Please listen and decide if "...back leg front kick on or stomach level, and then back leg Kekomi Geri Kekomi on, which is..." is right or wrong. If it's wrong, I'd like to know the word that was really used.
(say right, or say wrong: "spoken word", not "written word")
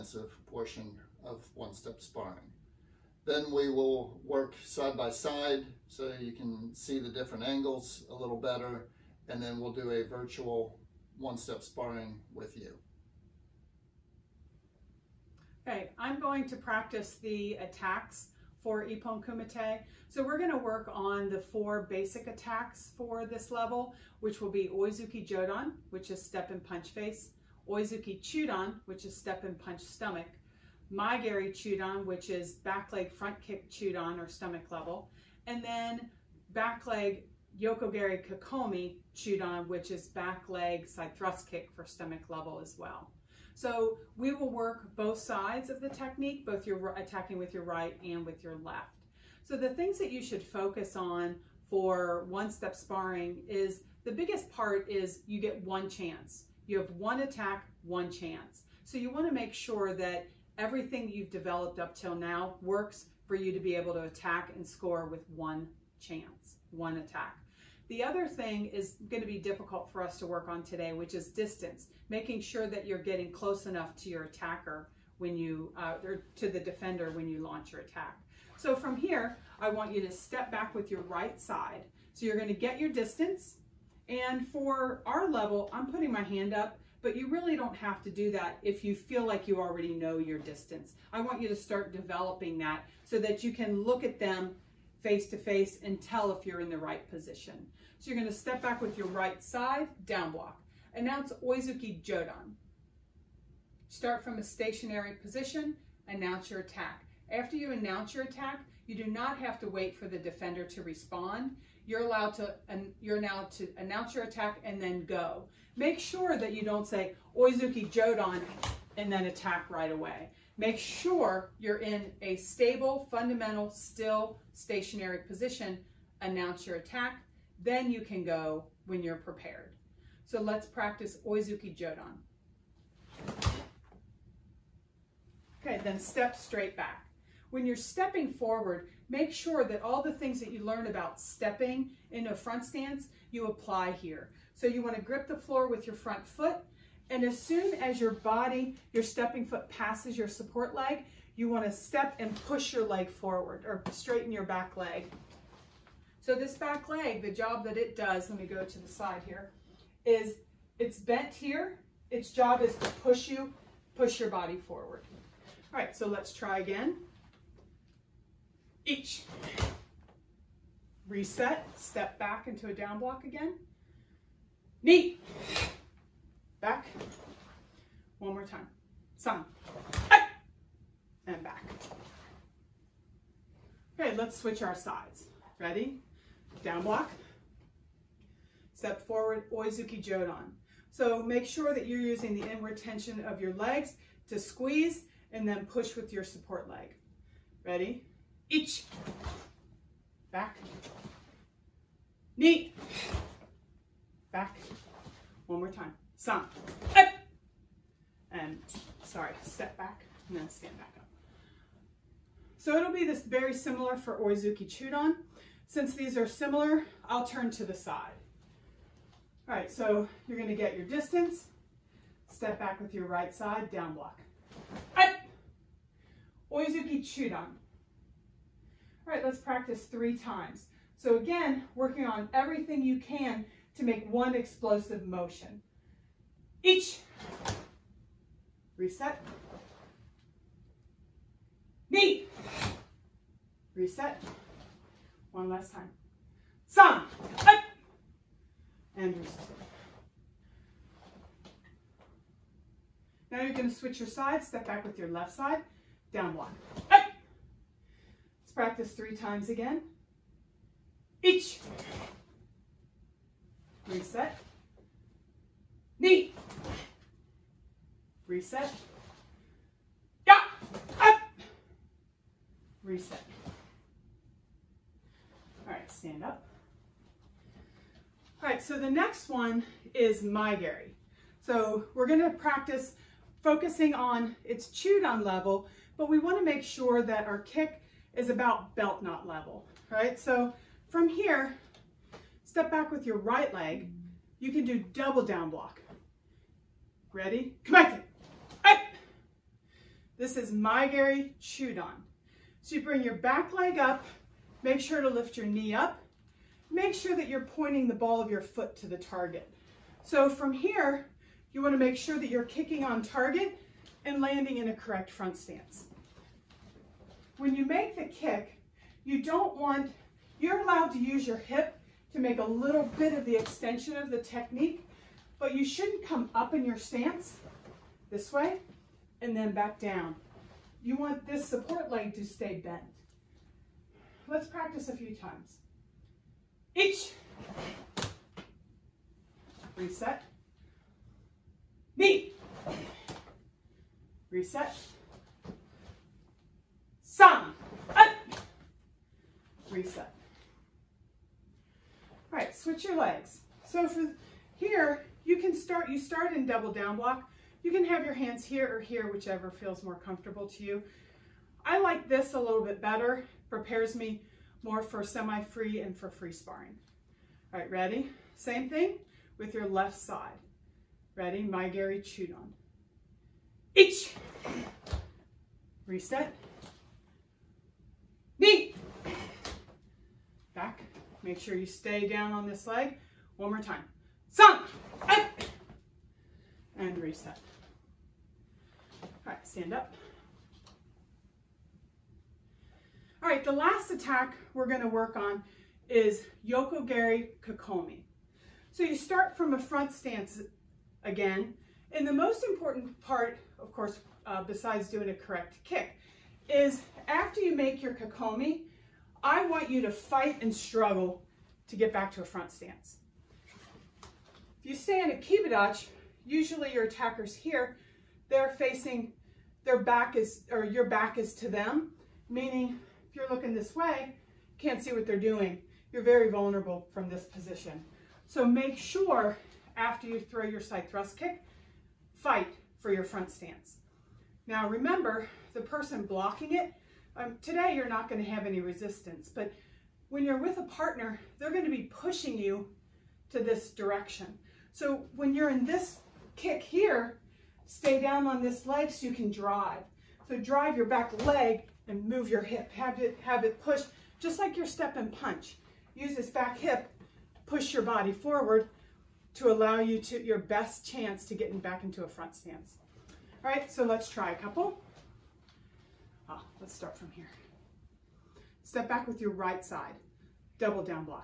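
wrong: "Yoko", not "Kekomi".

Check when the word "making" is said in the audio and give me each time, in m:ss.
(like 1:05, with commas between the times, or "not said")
1:12.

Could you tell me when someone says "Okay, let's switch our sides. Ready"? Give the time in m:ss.
3:03.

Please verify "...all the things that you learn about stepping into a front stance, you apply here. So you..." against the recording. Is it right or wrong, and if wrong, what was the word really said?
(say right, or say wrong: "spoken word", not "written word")
right.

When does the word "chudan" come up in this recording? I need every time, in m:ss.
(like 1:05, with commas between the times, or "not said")
0:28, 3:34, 3:47, 4:44, 6:11.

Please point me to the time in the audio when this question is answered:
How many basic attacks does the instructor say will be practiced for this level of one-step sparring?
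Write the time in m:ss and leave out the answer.
0:21.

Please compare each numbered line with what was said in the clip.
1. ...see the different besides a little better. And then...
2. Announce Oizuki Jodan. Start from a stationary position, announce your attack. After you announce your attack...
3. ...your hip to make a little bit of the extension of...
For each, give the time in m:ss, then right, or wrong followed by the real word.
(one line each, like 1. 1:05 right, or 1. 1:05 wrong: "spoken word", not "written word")
1. 0:06 wrong: "angles", not "besides"
2. 1:40 right
3. 5:21 right.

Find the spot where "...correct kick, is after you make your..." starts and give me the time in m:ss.
6:45.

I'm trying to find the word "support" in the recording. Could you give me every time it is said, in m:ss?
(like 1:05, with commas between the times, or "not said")
2:30, 3:16, 5:31.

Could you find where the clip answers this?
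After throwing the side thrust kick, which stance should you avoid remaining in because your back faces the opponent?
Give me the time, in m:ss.
6:55.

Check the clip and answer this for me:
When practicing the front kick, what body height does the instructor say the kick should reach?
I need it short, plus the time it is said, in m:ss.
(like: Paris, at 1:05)
Belt knot level, at 4:48.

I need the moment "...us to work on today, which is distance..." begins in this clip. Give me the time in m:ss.
1:10.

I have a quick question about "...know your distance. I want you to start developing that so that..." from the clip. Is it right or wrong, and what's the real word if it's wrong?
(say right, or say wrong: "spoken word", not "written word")
right.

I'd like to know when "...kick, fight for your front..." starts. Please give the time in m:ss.
7:11.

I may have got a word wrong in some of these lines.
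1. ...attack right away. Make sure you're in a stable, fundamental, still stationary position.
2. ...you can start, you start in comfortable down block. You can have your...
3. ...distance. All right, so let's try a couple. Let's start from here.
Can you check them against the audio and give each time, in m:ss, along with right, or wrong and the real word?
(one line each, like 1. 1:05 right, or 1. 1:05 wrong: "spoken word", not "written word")
1. 1:59 right
2. 5:55 wrong: "double", not "comfortable"
3. 7:42 wrong: "stance", not "distance".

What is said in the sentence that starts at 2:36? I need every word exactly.
So this back leg, the job that it does, let me go to the side here, is it's bent here.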